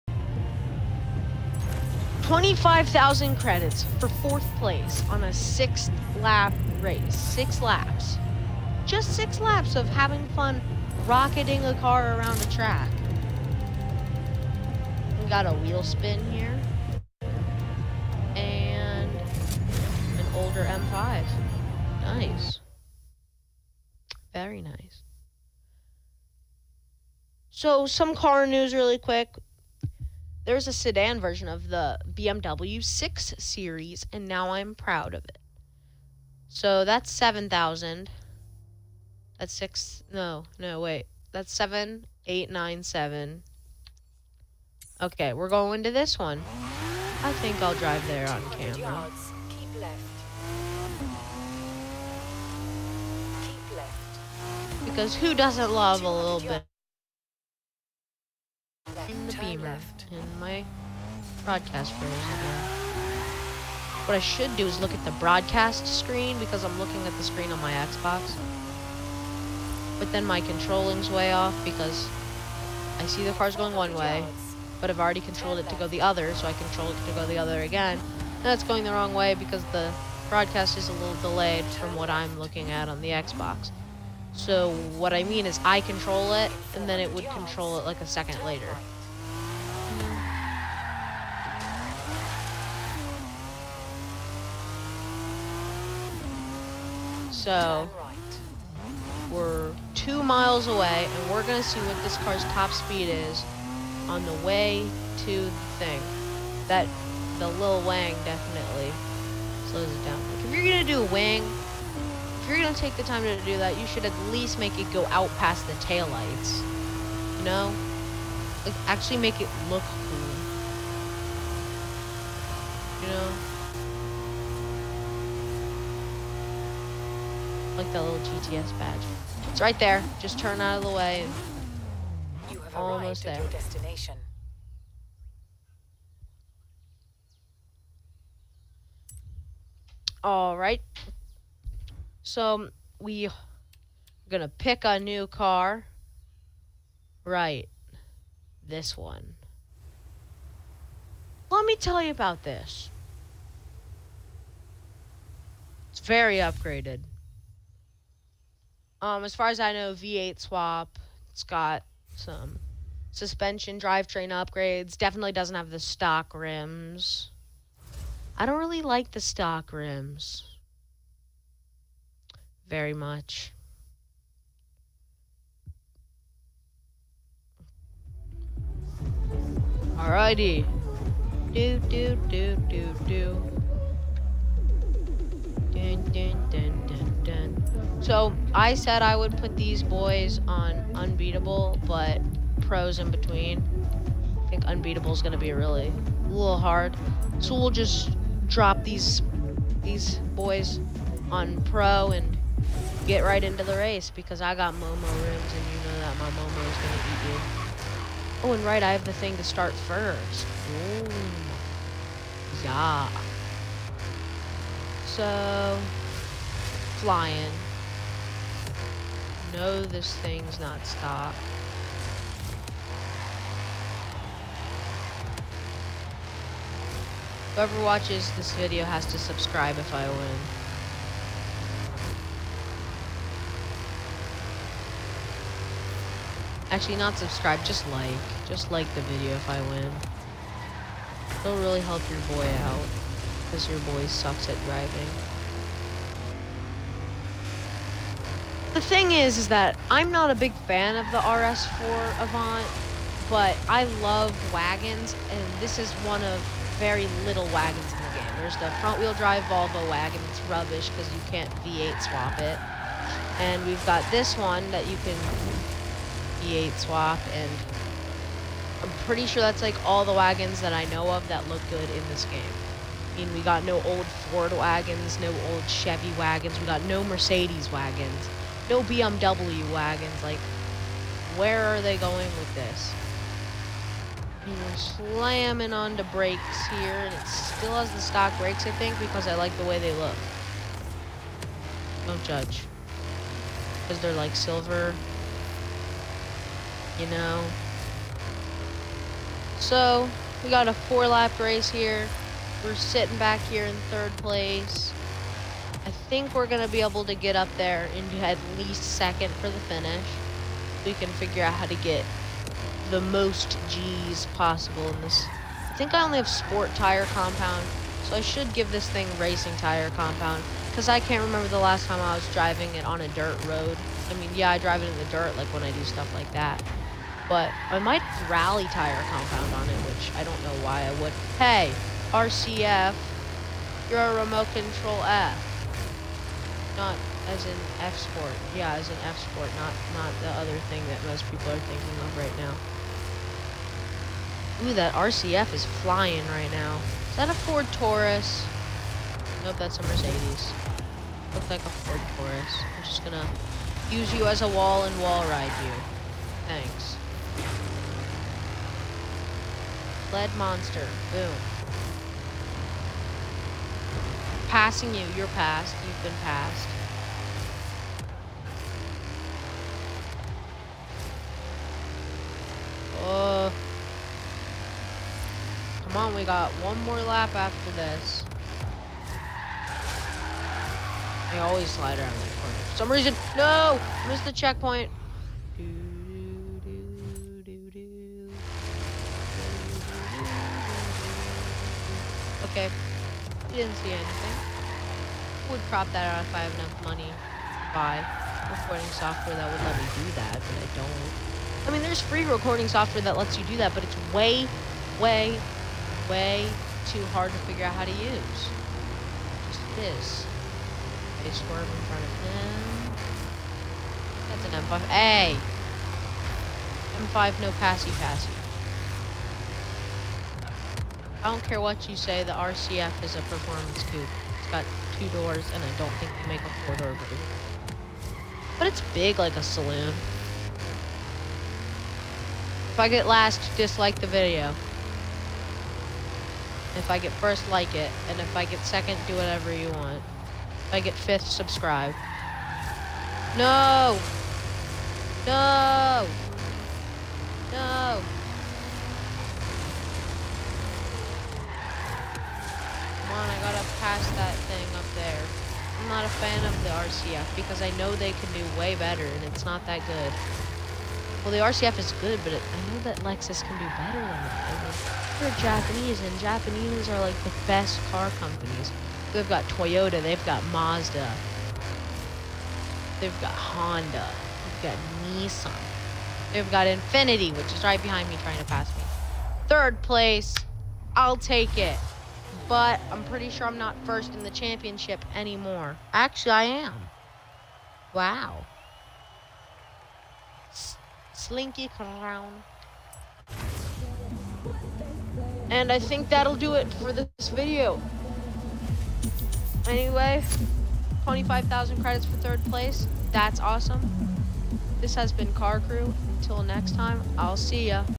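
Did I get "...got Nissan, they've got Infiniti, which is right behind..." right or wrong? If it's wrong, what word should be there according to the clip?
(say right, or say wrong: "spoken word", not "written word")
right.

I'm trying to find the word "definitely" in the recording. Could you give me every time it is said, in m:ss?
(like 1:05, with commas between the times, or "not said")
1:48, 2:44.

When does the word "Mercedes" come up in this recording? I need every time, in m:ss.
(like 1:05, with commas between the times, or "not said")
4:37, 5:49.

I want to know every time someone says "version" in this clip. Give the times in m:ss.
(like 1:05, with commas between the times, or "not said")
0:31, 7:06.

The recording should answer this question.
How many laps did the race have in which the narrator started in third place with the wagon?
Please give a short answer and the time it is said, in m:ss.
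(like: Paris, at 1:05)
4, at 5:00.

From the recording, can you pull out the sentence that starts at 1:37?
So we're two miles away, and we're going to see what this car's top speed is on the way to the thing.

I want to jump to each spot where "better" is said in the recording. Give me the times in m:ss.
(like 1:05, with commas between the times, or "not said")
7:38, 7:43.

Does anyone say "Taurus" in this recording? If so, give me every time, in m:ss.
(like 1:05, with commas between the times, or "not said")
5:47, 5:52.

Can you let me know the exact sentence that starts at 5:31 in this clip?
Hey, RCF, you're a remote control F not as in F-Sport.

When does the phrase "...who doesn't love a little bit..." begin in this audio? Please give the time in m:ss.
0:55.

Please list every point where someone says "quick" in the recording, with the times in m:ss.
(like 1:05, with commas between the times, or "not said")
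0:28.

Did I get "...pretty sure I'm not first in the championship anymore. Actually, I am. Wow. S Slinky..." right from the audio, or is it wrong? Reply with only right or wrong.
right.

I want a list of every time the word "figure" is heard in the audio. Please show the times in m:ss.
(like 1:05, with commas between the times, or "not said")
5:11, 6:47.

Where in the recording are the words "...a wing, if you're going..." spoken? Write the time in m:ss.
1:51.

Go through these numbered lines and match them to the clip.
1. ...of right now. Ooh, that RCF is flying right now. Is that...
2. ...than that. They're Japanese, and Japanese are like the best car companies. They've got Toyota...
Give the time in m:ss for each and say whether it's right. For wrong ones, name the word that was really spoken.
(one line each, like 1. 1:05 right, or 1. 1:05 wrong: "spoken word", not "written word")
1. 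5:42 right
2. 7:43 right.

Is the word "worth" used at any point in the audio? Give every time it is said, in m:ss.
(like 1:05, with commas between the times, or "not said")
not said.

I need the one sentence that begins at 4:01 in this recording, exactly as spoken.
It'll really help your boy out, because your boy sucks at driving.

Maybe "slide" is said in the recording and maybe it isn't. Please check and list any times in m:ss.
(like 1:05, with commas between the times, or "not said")
6:21.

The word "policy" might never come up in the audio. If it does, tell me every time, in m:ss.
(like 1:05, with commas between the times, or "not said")
not said.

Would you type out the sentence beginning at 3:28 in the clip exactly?
Oh, and right, I have the thing to start first.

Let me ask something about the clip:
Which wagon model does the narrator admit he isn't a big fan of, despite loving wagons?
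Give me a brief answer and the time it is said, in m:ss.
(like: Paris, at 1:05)
RS4 Avant, at 4:11.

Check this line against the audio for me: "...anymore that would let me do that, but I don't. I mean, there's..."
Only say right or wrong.
wrong.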